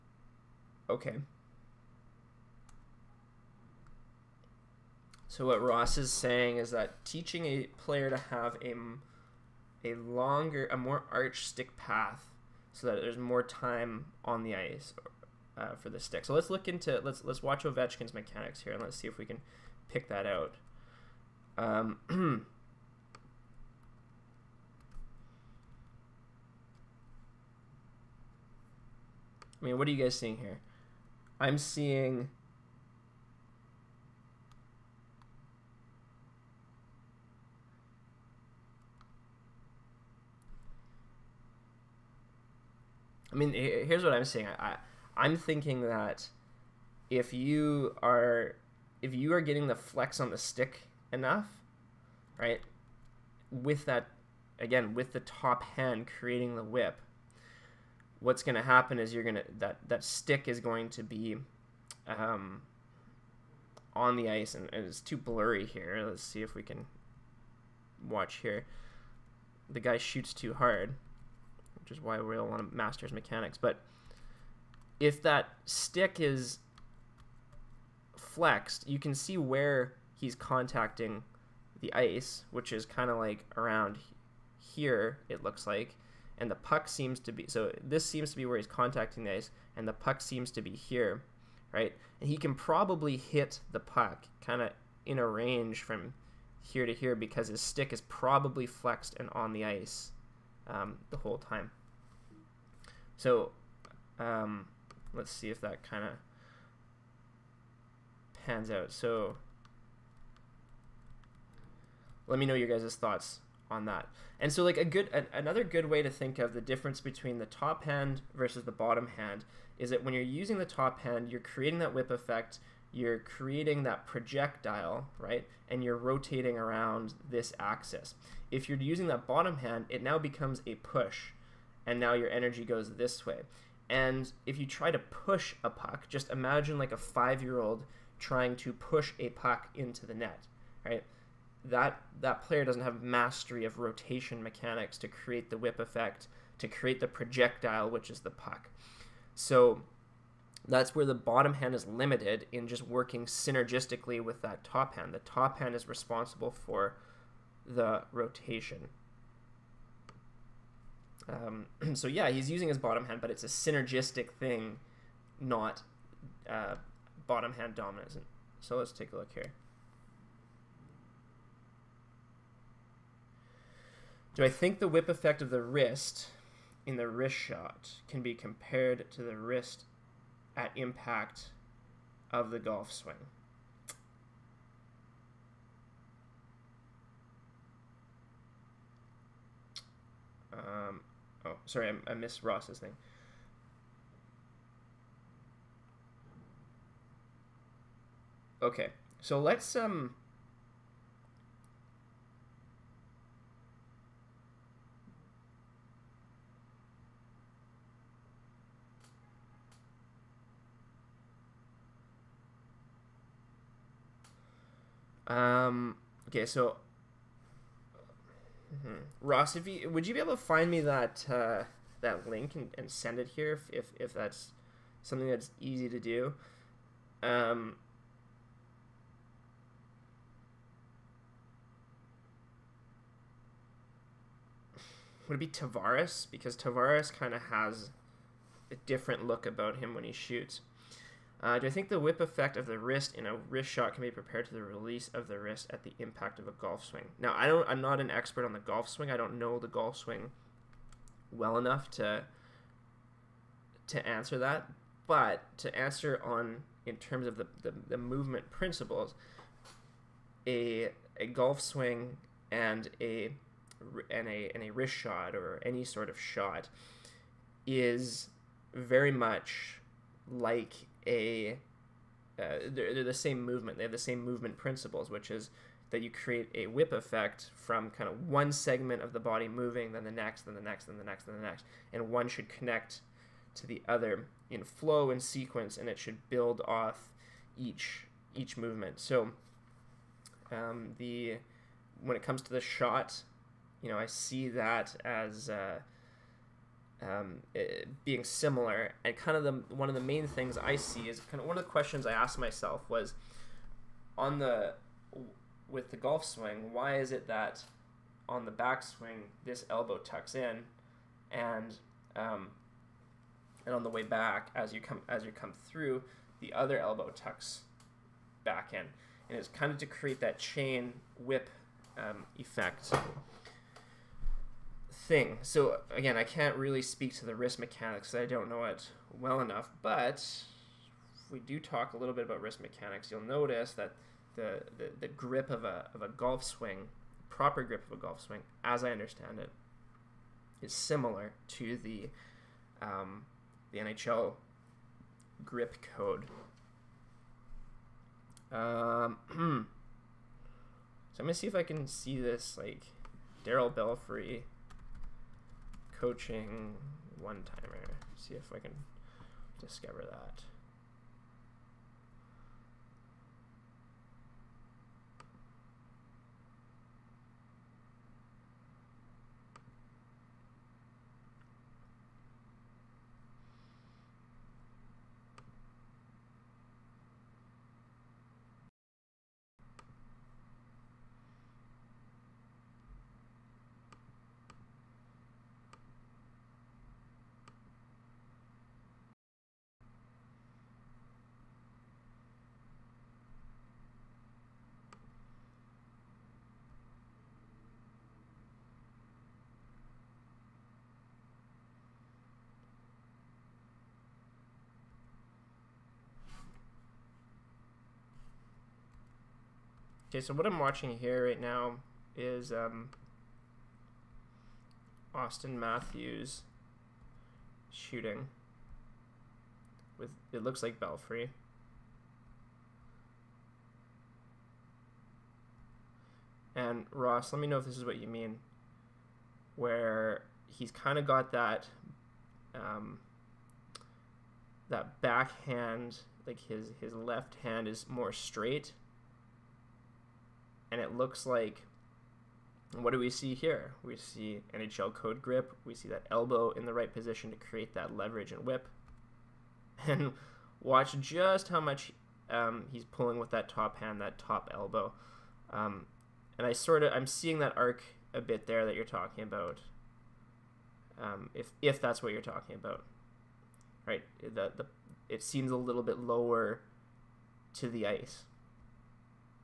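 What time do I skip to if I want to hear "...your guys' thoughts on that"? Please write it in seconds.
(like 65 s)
112 s.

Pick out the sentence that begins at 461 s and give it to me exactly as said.
Um, if if that's what you're talking about, right?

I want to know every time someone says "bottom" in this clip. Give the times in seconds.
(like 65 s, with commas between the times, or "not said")
118 s, 129 s, 151 s, 162 s, 167 s.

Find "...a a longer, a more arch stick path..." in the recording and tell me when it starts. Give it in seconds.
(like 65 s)
8 s.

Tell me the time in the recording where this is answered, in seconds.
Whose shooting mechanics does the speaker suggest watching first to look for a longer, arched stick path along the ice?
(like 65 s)
17 s.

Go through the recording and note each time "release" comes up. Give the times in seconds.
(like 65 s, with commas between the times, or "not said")
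244 s.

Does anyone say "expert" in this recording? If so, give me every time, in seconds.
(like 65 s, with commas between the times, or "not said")
248 s.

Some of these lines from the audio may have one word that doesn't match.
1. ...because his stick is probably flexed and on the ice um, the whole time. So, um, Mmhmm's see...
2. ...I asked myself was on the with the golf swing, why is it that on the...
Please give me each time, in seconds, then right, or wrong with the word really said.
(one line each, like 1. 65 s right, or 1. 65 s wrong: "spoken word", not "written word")
1. 97 s wrong: "Let", not "Mmhmm"
2. 302 s right.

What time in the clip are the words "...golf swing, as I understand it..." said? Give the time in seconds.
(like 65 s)
337 s.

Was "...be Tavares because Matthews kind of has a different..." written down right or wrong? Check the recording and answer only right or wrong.
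wrong.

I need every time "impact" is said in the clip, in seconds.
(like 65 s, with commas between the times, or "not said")
180 s, 245 s.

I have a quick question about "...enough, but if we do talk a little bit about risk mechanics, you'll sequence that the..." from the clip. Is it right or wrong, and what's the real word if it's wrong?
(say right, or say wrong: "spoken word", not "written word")
wrong: "notice", not "sequence".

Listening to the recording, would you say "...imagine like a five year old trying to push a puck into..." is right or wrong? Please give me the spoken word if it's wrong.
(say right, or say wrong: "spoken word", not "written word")
right.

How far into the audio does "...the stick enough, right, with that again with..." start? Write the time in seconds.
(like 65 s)
50 s.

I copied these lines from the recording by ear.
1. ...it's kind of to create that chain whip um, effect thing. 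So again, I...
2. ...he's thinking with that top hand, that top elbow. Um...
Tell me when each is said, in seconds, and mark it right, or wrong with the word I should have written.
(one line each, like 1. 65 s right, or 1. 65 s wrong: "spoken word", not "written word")
1. 319 s right
2. 452 s wrong: "pulling", not "thinking".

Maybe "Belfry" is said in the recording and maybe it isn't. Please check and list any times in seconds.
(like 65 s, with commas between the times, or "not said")
353 s, 420 s.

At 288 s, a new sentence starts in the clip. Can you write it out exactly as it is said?
So um, the when it comes to the shot, you know, I see that as uh, um, eh, being similar.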